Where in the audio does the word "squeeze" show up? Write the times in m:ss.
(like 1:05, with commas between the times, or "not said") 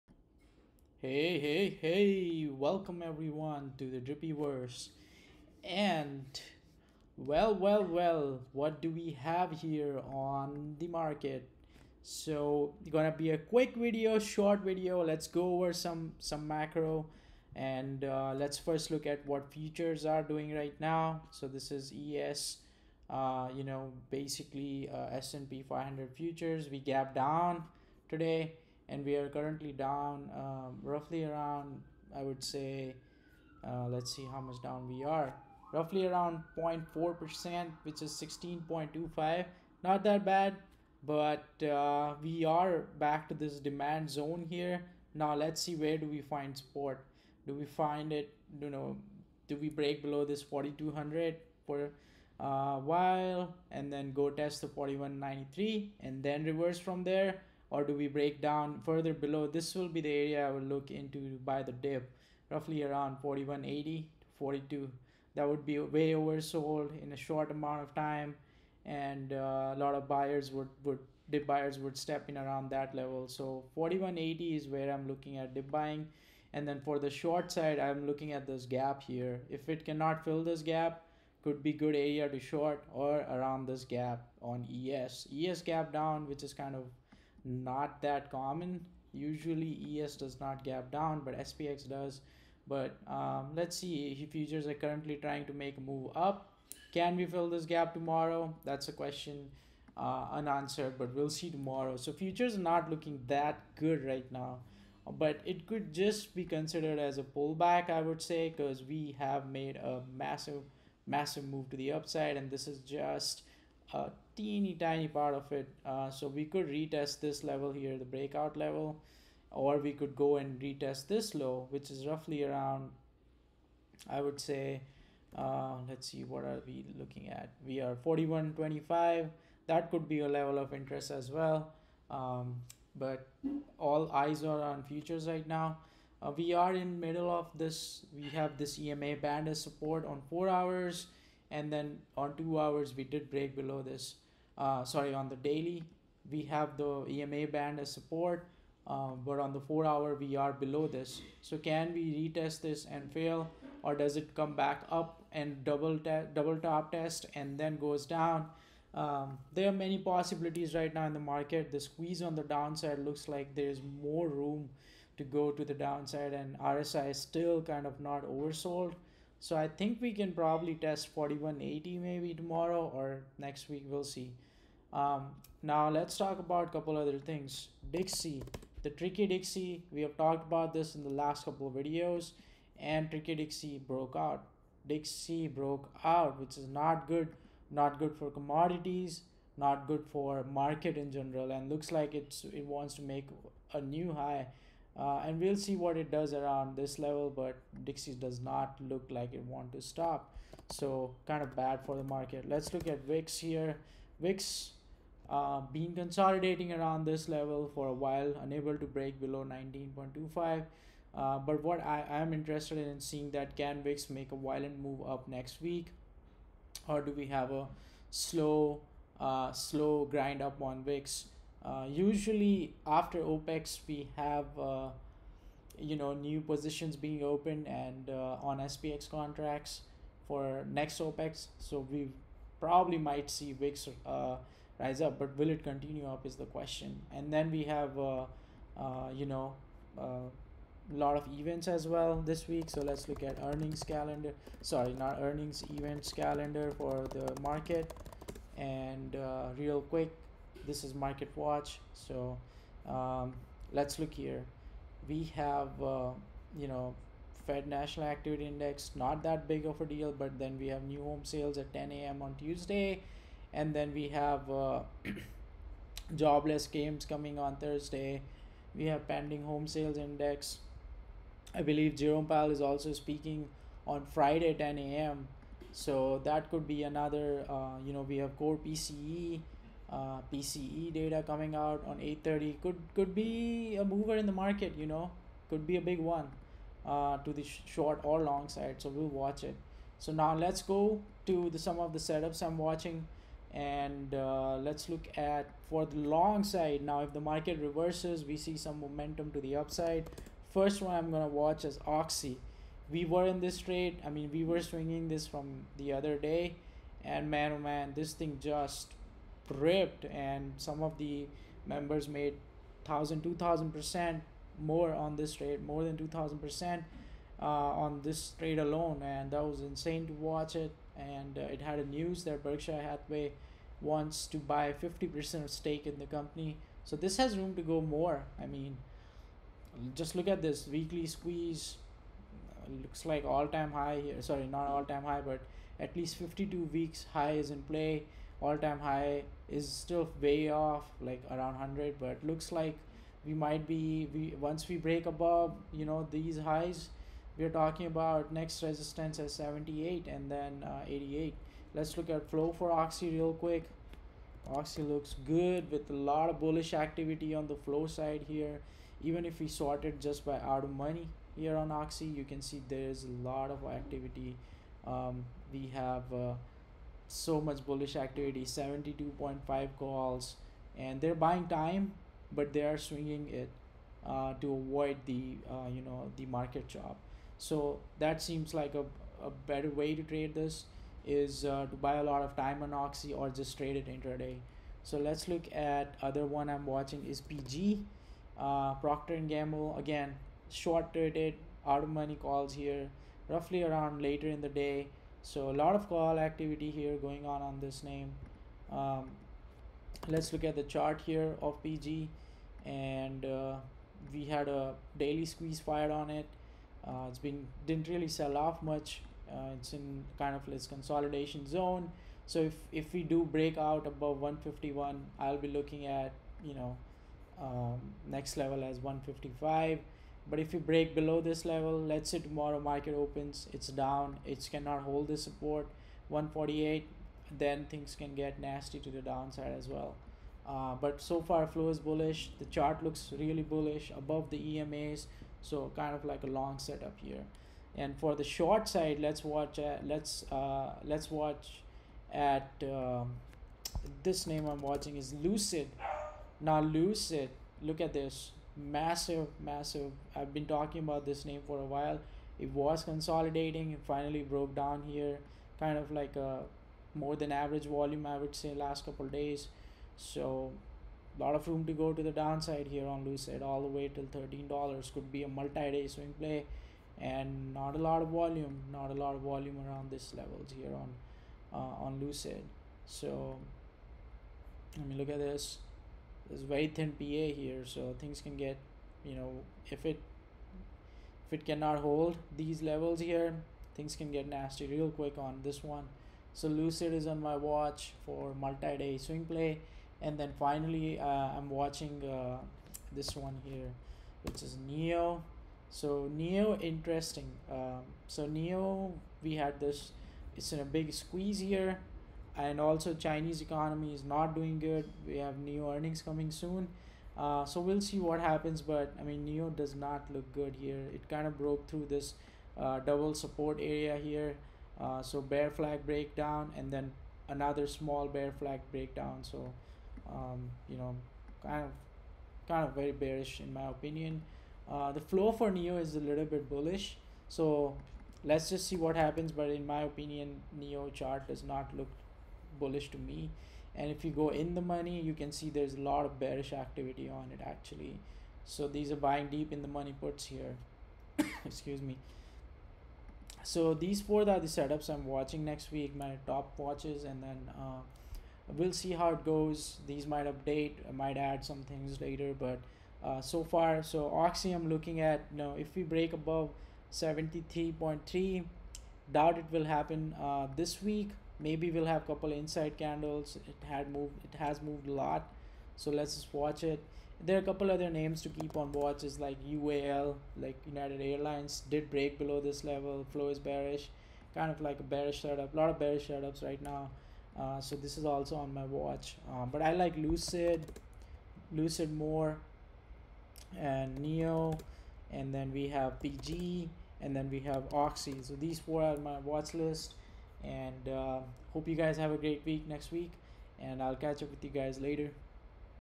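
2:41, 5:31, 6:45, 8:20.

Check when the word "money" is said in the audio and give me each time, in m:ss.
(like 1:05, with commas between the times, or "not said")
6:00, 6:31, 8:54, 8:59.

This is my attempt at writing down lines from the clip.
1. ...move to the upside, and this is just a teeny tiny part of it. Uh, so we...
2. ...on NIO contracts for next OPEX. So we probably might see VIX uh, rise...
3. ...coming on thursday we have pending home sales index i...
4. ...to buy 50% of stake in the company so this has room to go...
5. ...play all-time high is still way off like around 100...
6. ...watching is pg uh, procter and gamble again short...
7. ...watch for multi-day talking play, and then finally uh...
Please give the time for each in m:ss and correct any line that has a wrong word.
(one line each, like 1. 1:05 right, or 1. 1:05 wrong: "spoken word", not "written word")
1. 1:51 right
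2. 3:48 wrong: "SPX", not "NIO"
3. 4:27 right
4. 5:24 right
5. 5:37 right
6. 6:26 right
7. 8:07 wrong: "swing", not "talking".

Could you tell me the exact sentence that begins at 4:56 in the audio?
Now, if the market reverses, we see some momentum to the upside.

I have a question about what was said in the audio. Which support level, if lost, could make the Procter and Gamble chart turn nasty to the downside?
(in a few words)
148.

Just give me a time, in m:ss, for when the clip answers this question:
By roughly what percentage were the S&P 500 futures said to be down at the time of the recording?
0:36.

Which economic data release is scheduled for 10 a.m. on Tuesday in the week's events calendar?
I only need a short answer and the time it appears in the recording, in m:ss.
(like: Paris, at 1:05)
new home sales, at 4:20.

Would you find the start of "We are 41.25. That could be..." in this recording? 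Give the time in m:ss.
2:07.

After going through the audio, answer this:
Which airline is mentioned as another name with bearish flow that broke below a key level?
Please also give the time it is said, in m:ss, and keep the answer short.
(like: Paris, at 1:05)
United Airlines, at 9:30.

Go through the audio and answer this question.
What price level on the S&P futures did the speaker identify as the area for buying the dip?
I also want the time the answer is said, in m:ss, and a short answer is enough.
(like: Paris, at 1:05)
4180, at 1:13.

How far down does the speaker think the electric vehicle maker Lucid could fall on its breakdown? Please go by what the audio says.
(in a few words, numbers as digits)
$13.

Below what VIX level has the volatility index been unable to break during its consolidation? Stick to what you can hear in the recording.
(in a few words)
19.25.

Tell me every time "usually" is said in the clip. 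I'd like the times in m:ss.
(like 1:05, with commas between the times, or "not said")
1:29, 3:41.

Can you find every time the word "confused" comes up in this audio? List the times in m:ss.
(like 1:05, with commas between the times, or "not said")
not said.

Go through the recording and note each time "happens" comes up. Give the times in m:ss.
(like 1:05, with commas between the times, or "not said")
8:28, 8:48, 9:19.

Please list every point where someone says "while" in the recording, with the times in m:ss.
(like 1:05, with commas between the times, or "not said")
0:52, 3:27, 7:31.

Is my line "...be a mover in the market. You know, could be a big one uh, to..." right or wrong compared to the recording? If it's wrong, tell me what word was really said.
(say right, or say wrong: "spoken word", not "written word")
right.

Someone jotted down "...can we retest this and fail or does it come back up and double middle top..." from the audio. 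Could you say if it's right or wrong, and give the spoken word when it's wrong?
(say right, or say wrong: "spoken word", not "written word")
wrong: "double", not "middle".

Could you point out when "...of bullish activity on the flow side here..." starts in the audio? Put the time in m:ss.
5:56.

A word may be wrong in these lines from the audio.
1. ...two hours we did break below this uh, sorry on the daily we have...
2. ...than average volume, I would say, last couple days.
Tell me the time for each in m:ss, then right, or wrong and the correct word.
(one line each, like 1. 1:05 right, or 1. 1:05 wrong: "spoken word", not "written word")
1. 2:22 right
2. 7:37 right.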